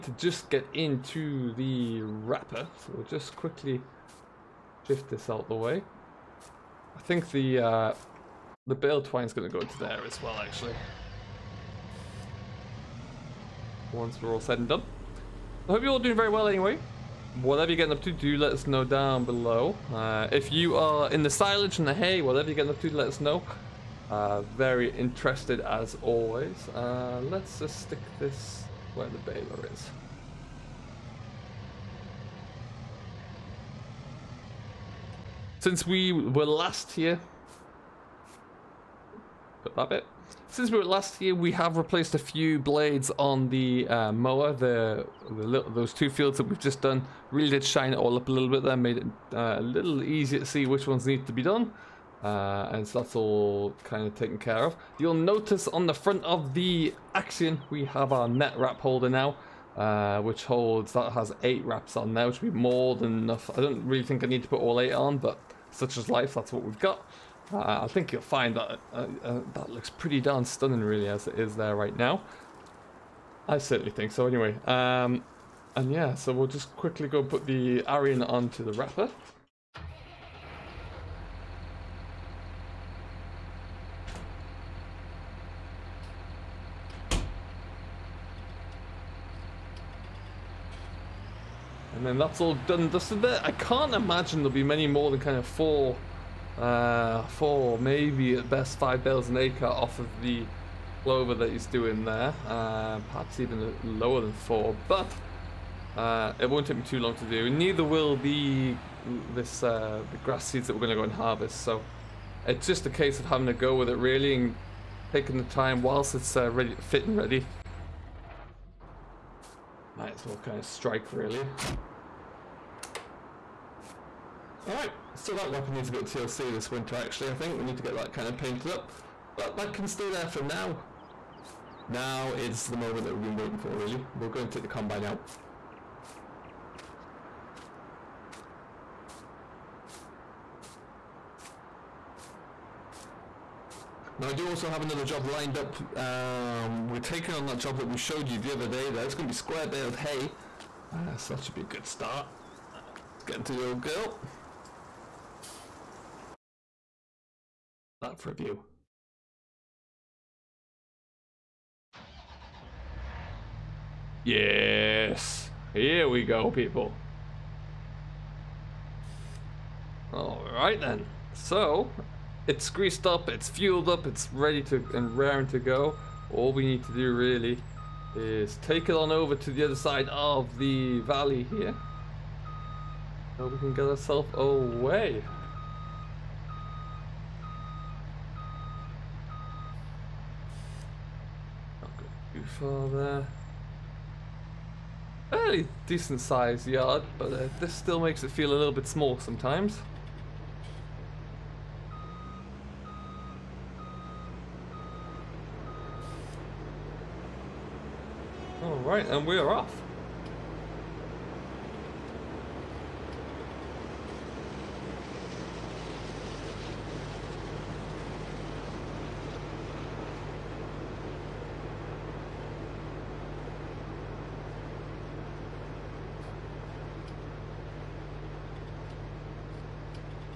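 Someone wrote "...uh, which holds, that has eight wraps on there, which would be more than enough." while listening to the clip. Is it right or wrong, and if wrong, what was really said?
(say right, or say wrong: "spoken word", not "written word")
right.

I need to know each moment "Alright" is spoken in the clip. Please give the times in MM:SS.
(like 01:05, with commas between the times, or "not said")
02:04, 02:50, 03:28.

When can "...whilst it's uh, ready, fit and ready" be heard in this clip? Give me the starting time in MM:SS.
01:55.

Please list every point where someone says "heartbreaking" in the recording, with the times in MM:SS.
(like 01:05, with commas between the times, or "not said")
not said.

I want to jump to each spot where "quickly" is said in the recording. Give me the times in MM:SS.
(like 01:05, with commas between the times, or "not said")
00:03, 01:16.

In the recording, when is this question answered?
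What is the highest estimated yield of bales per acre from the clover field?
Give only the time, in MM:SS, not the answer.
01:38.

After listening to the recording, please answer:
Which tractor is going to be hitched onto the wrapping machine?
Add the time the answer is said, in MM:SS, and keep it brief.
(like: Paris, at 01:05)
Arion, at 01:17.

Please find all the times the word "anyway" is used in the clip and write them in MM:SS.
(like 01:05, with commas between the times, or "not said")
00:16, 01:14.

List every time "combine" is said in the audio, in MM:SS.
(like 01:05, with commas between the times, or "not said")
02:14.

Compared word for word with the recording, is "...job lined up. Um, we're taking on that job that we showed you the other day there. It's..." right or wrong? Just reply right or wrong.
right.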